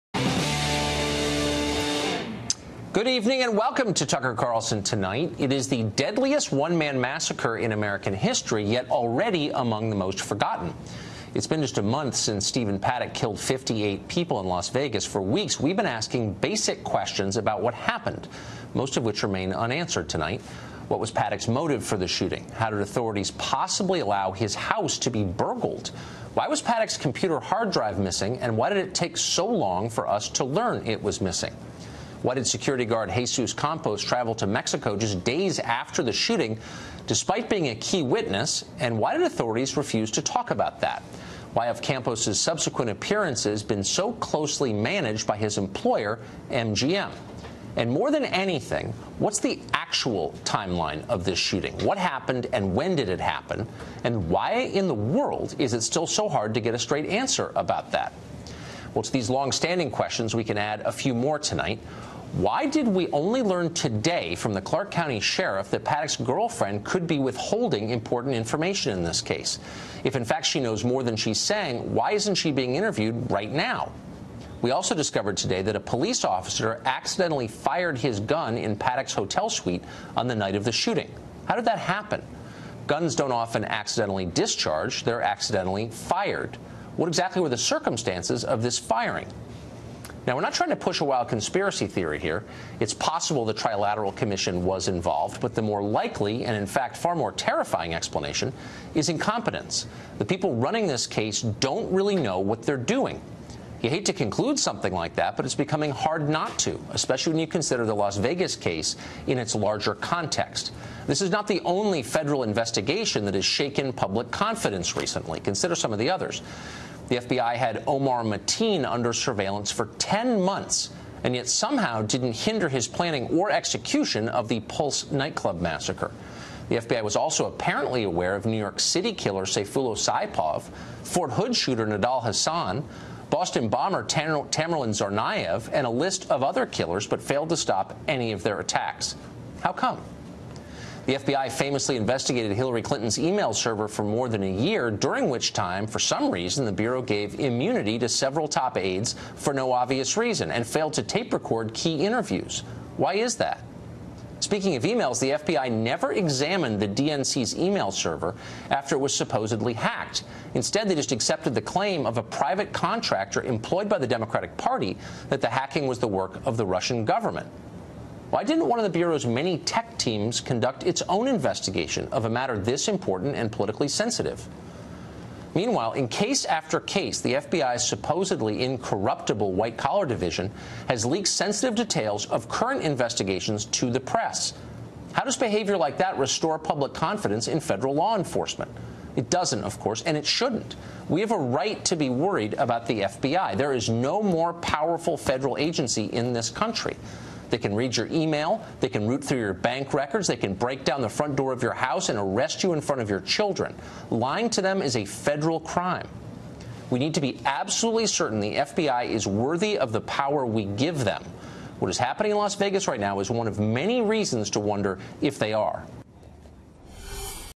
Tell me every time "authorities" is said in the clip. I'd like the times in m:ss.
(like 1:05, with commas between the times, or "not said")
0:22, 0:39.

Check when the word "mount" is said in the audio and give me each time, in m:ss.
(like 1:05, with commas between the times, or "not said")
not said.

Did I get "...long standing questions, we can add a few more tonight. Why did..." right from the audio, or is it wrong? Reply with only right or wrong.
right.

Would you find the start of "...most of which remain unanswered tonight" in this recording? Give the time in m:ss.
0:18.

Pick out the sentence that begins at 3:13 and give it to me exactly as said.
There is no more powerful federal agency in this country.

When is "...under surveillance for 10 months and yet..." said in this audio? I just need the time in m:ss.
1:58.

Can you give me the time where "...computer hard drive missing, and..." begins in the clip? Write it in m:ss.
0:26.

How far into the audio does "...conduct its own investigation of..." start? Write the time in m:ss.
2:50.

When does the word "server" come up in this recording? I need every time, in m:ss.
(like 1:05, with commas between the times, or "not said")
2:23, 2:37.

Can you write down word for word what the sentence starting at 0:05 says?
It is the deadliest one man massacre in American history, yet already among the most forgotten.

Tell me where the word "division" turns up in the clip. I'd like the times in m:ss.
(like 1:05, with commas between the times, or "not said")
3:00.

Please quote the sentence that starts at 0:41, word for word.
Why have Campos's subsequent appearances been so closely managed by his employer, MGM?